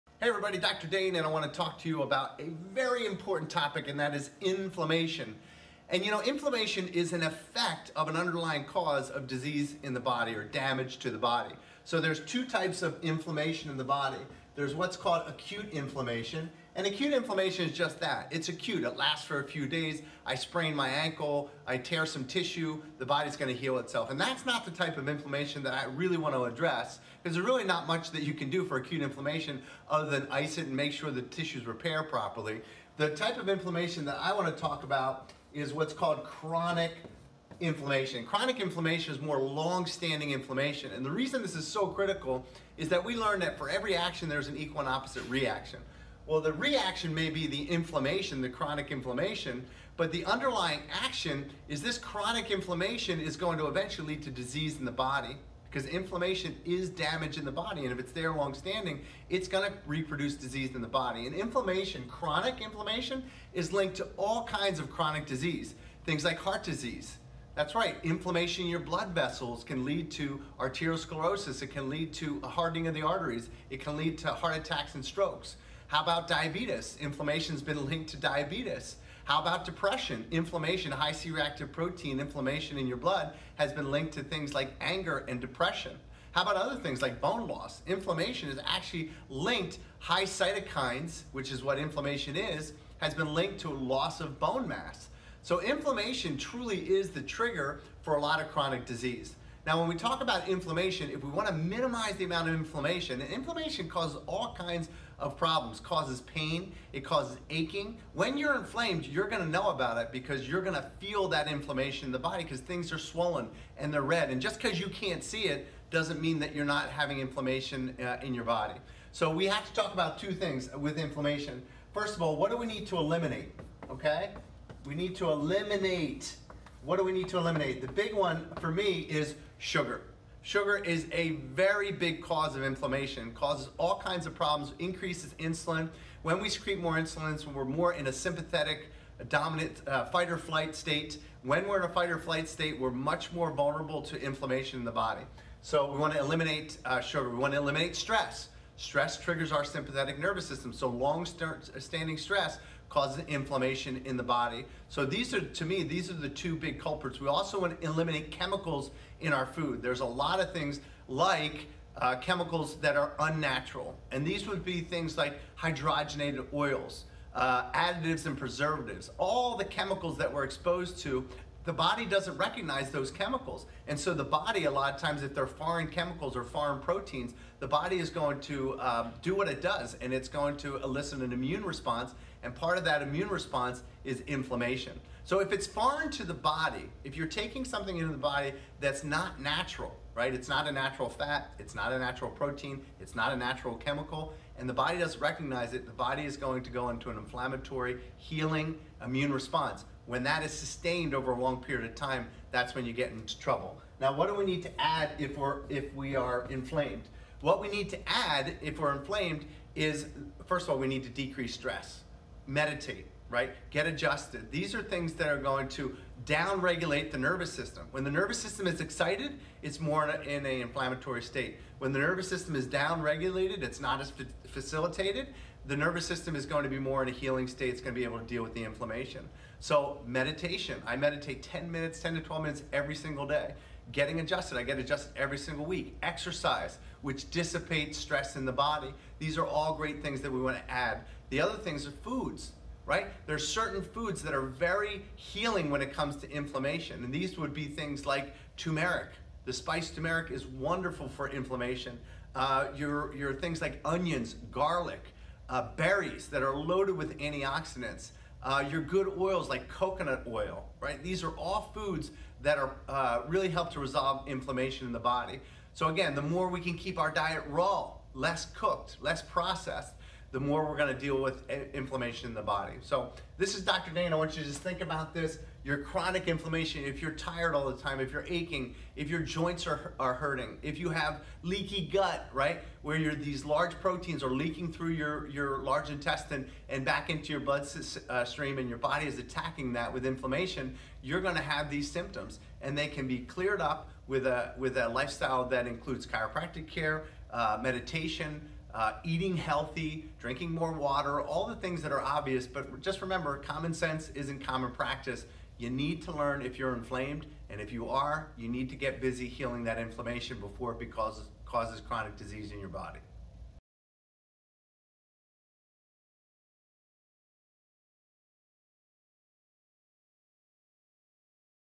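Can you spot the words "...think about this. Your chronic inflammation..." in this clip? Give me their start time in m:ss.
4:34.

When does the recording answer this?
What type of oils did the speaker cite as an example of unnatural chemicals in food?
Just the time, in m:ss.
2:45.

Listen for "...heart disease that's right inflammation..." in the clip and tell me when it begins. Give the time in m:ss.
1:06.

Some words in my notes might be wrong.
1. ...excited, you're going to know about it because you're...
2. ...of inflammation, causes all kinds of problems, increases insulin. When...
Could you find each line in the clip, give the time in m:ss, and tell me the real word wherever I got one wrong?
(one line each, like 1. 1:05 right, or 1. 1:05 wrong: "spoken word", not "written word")
1. 1:48 wrong: "inflamed", not "excited"
2. 2:12 right.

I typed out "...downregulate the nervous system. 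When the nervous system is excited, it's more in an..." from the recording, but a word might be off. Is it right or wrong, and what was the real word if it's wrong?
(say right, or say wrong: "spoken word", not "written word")
right.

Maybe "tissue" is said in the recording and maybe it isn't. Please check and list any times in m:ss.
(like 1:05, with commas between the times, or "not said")
0:22, 0:31.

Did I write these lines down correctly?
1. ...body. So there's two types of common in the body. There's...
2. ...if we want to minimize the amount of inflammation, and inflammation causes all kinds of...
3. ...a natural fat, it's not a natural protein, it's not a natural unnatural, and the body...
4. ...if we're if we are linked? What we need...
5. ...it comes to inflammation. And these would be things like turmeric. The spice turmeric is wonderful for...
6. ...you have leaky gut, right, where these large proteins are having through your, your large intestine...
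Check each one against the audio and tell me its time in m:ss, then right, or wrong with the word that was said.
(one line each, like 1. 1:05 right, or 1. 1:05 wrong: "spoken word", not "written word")
1. 0:11 wrong: "inflammation", not "common"
2. 1:41 right
3. 3:10 wrong: "chemical", not "unnatural"
4. 3:25 wrong: "inflamed", not "linked"
5. 4:05 right
6. 4:40 wrong: "leaking", not "having".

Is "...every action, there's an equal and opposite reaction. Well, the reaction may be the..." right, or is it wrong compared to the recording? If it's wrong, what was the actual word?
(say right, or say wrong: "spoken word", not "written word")
right.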